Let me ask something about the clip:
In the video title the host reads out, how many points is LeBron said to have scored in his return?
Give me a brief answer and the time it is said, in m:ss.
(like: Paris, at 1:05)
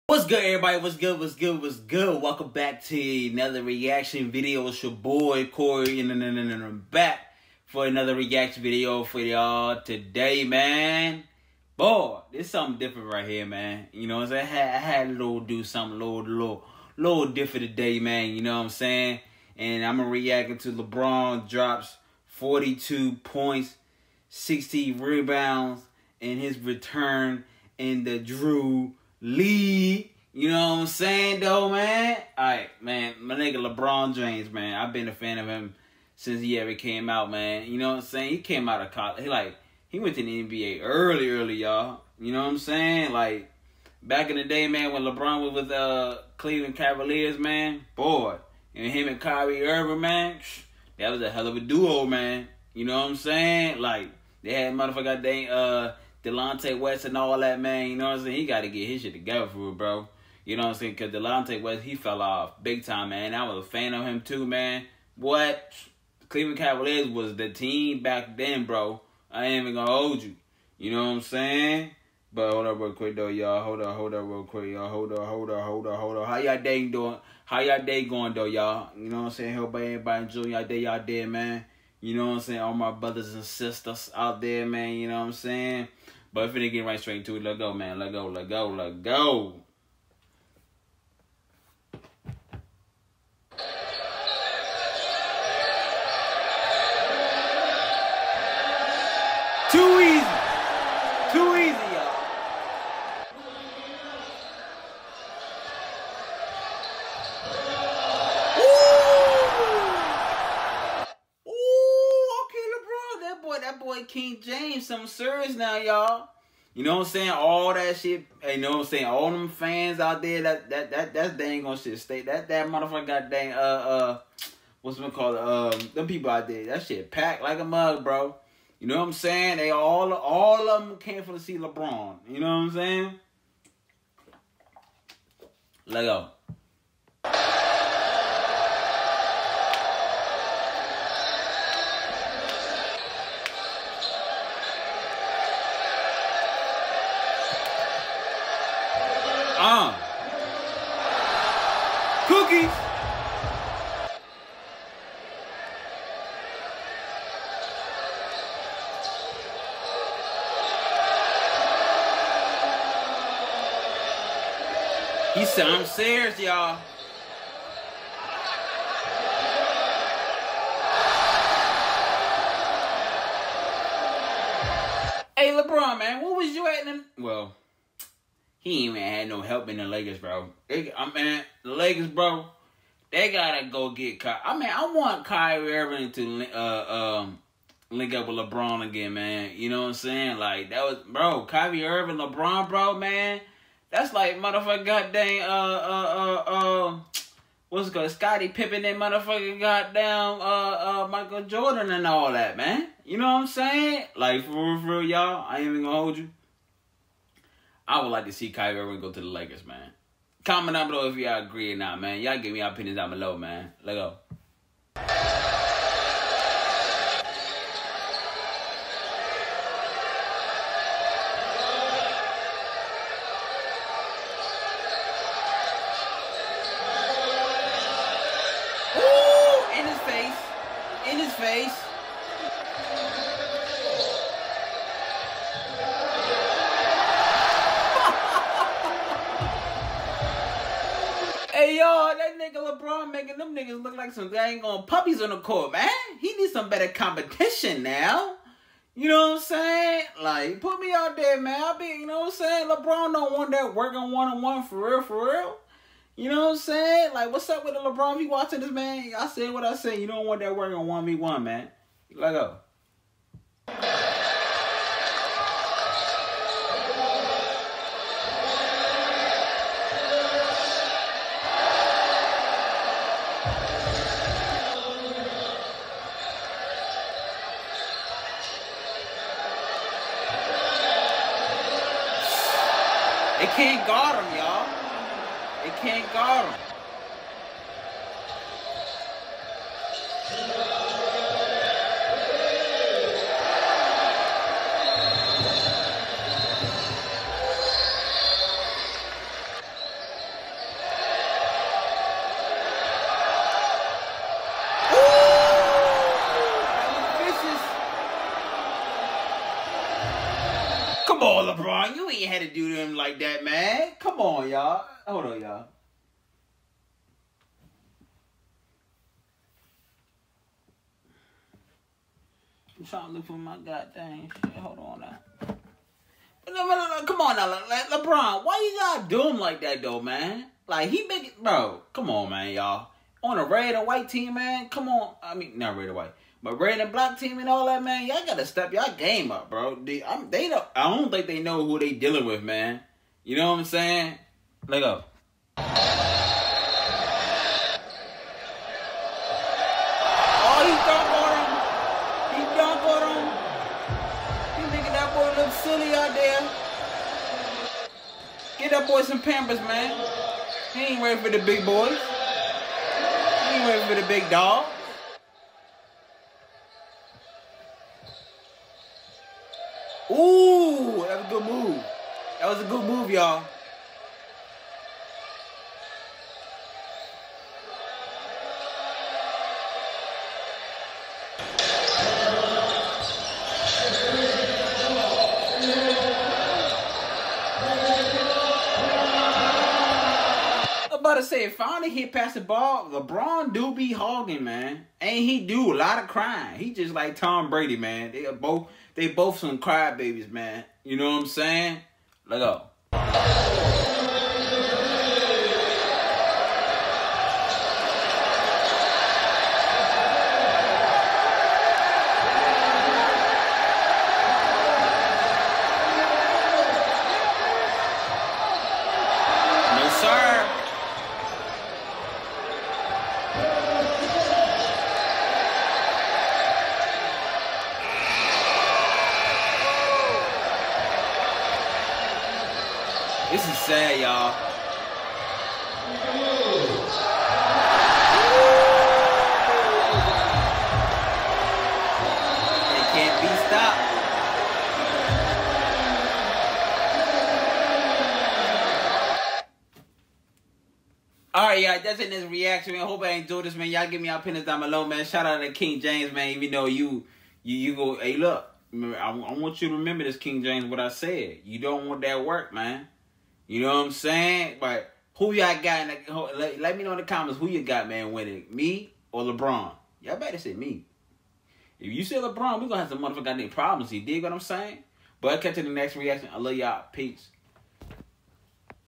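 42, at 0:22.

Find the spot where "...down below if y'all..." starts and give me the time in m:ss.
3:30.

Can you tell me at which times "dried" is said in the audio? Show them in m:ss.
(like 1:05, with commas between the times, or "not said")
not said.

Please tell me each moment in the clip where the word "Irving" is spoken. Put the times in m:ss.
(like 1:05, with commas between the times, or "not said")
0:49, 3:05, 3:11, 3:28.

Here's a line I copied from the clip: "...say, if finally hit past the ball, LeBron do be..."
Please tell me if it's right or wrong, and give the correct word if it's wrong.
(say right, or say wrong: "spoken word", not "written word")
right.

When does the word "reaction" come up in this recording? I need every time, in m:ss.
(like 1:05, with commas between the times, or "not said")
0:03, 0:08, 7:32, 7:55.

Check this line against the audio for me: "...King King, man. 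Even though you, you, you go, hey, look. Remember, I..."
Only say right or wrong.
wrong.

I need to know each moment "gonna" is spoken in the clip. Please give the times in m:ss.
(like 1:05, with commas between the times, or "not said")
1:09, 3:25.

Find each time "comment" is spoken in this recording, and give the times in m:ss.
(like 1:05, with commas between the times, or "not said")
3:30, 7:47.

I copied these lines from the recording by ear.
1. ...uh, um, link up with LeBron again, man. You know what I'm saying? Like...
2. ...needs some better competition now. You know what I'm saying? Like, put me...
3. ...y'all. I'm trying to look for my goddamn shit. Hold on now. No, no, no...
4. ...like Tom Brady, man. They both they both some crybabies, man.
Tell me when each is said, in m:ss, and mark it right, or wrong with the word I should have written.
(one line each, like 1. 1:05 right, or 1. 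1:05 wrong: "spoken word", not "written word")
1. 3:06 right
2. 4:06 right
3. 5:15 right
4. 6:36 right.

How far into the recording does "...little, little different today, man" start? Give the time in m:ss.
0:16.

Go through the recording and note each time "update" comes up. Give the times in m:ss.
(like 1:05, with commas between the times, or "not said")
not said.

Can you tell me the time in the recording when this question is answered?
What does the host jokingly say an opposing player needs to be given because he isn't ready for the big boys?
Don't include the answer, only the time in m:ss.
5:59.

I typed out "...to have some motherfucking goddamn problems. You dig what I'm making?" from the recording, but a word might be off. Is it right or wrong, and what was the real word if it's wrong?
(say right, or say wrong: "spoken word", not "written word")
wrong: "saying", not "making".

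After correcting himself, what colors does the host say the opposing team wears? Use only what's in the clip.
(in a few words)
Red and Black.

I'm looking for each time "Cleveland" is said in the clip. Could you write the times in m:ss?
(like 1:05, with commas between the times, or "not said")
0:46, 1:06.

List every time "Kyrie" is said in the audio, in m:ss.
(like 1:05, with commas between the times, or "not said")
0:49, 3:05, 3:11, 3:28.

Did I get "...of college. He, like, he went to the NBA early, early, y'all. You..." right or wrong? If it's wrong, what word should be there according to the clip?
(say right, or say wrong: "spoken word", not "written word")
right.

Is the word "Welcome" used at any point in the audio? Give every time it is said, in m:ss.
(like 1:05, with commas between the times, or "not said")
0:02.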